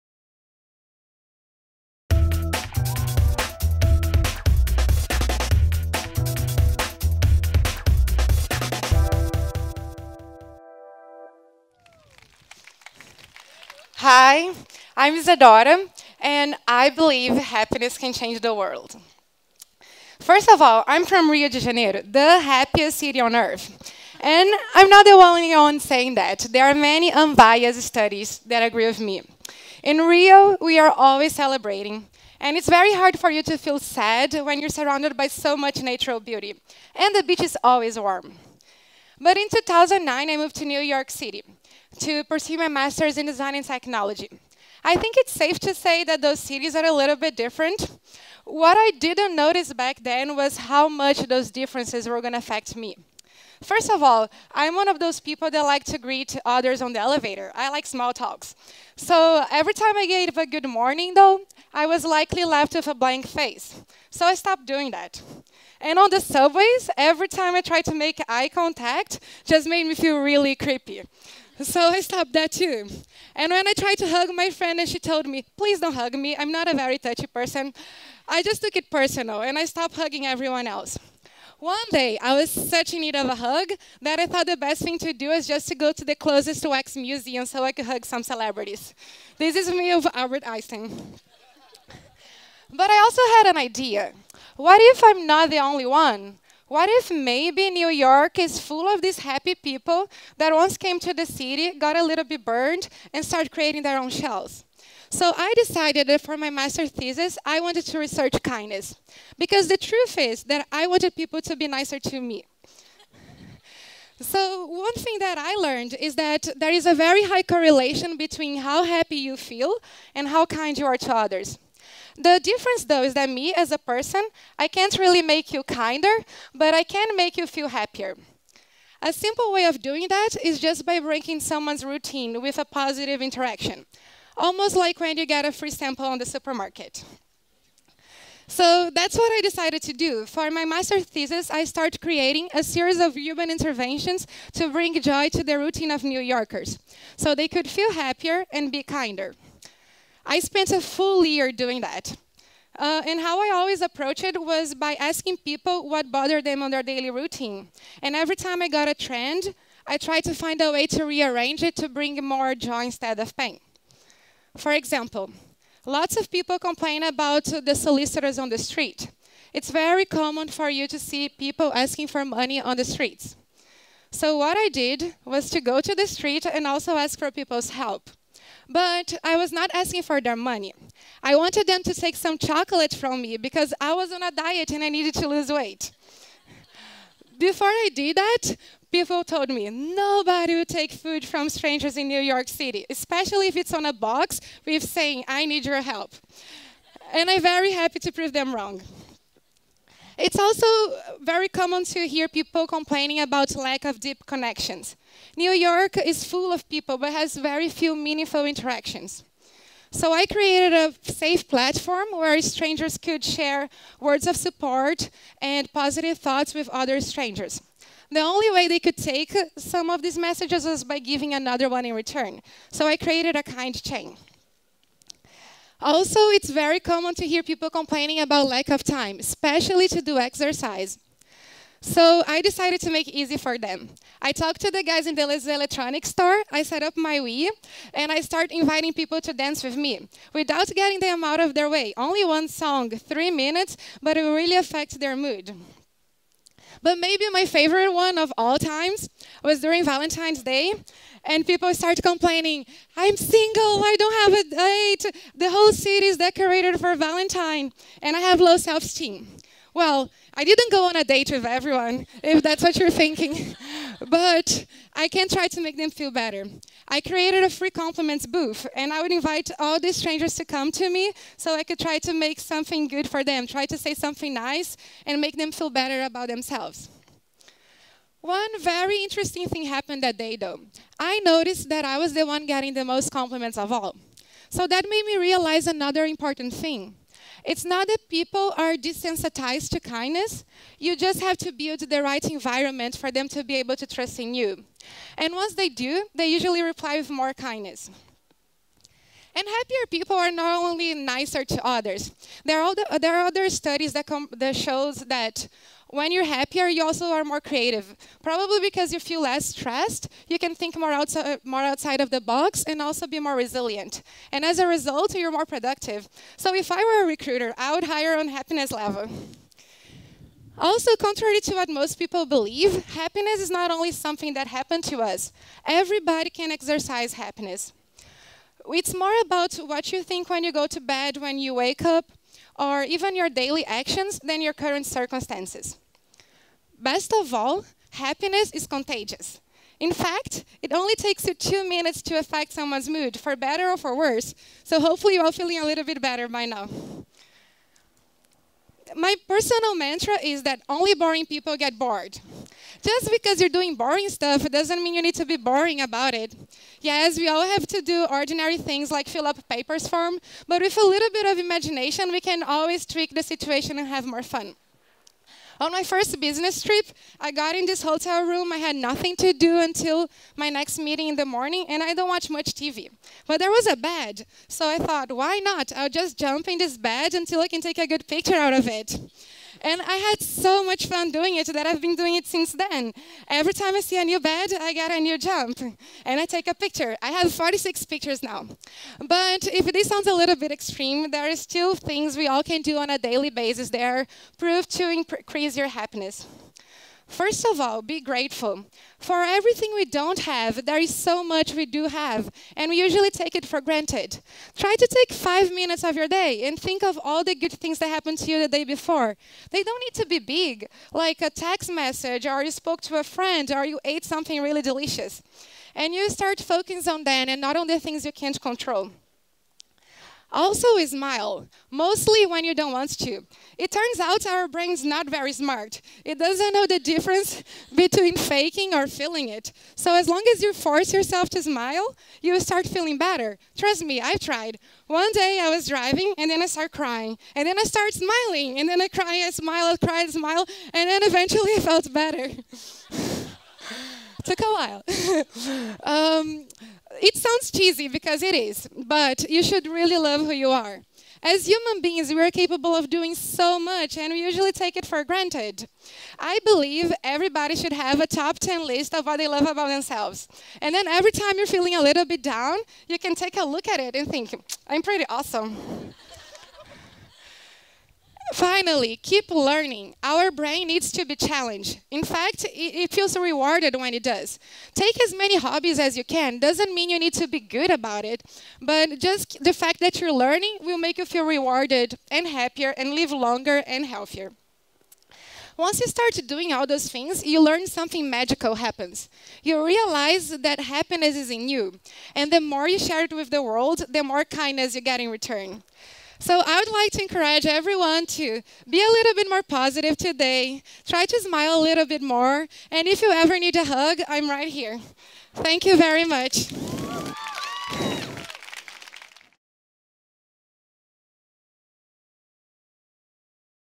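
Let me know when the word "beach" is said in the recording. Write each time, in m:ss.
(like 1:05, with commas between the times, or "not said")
0:37.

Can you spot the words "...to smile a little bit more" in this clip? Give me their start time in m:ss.
8:21.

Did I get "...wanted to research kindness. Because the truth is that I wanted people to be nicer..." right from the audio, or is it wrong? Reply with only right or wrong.
right.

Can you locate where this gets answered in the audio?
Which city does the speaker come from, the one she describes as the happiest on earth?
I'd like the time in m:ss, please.
0:21.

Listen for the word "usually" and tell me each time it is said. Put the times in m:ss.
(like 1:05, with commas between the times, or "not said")
4:56, 6:42, 7:34.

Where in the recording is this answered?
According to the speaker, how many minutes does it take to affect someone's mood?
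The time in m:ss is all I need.
5:41.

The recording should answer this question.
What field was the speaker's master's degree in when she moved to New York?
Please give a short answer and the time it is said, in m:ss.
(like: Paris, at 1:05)
design and technology, at 0:43.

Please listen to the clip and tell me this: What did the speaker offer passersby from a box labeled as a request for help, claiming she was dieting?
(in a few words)
chocolate.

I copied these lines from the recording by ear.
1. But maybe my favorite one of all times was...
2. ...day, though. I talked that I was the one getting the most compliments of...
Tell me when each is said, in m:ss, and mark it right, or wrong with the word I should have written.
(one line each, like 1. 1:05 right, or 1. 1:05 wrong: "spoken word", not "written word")
1. 4:06 right
2. 4:40 wrong: "noticed", not "talked".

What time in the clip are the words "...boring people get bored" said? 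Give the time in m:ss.
5:50.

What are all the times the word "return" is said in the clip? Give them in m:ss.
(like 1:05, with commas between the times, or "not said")
3:41, 8:15.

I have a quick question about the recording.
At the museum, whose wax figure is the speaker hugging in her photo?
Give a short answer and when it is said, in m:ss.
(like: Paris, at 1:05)
Albert Einstein, at 1:30.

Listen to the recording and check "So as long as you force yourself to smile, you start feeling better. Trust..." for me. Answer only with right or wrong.
right.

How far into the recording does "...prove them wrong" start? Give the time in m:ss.
3:18.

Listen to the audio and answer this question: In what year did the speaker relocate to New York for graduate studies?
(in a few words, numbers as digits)
2009.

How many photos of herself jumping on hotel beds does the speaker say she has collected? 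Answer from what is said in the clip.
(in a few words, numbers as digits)
46.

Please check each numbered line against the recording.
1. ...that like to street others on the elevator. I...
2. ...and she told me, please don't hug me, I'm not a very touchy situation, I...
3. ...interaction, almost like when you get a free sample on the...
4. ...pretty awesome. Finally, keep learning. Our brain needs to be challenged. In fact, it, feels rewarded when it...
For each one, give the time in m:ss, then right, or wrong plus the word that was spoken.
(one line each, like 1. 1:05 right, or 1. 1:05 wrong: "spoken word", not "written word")
1. 0:55 wrong: "greet", not "street"
2. 1:14 wrong: "person", not "situation"
3. 2:13 right
4. 7:44 right.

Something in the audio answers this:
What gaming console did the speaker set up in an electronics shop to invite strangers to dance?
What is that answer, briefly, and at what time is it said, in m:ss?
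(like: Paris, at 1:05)
Wii, at 3:57.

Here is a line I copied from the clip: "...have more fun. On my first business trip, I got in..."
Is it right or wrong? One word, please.
right.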